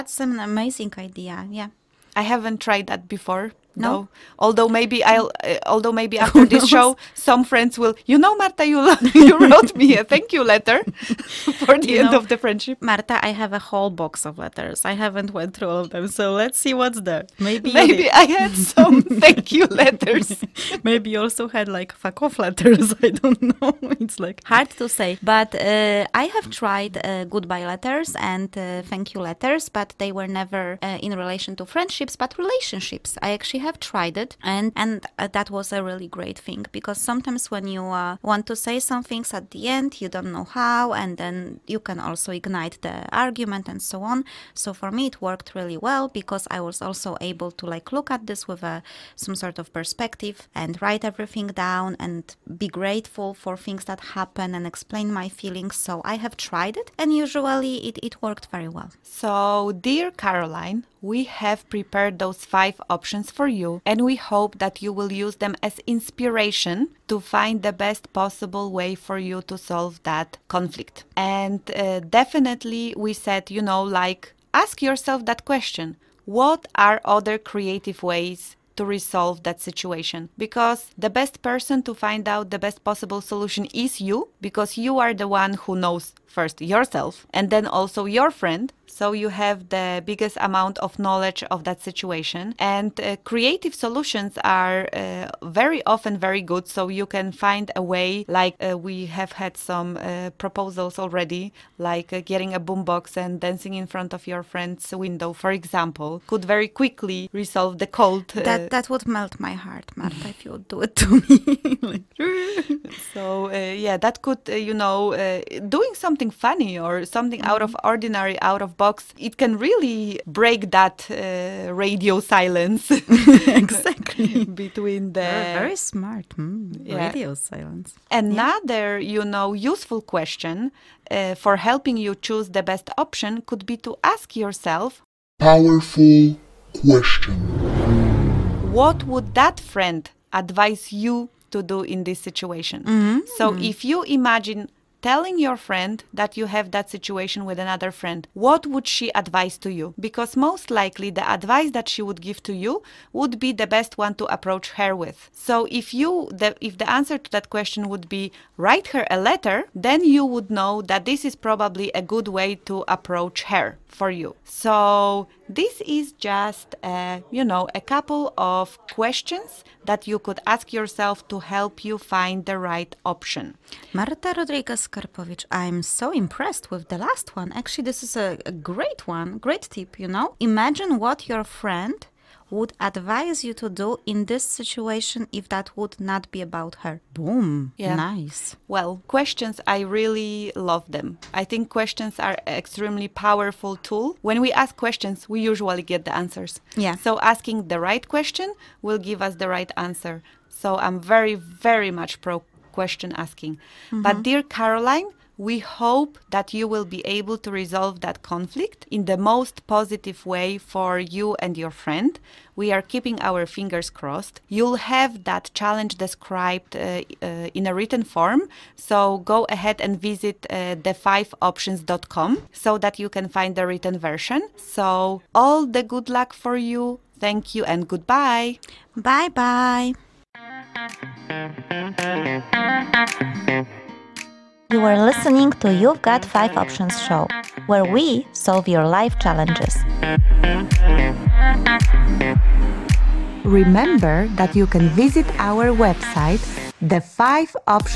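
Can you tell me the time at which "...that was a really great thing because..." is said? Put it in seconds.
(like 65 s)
35 s.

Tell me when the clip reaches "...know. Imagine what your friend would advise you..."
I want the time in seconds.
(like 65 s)
180 s.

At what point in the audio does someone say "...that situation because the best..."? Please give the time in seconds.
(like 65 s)
79 s.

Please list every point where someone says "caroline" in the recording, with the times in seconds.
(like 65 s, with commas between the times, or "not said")
60 s, 204 s.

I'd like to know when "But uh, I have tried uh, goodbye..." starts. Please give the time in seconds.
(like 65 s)
25 s.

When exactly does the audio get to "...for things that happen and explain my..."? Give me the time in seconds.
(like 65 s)
53 s.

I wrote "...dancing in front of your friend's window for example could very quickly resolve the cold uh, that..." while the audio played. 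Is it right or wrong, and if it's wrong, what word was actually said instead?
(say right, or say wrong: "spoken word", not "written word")
right.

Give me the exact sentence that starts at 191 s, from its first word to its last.
I think questions are extremely powerful tool.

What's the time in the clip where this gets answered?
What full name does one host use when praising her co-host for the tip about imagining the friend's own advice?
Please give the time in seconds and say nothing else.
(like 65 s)
173 s.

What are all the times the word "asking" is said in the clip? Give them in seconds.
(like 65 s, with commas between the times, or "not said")
197 s, 203 s.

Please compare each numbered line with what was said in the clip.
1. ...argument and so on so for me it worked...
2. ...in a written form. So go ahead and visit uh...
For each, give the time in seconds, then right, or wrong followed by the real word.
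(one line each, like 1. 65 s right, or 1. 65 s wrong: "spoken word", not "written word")
1. 43 s right
2. 217 s right.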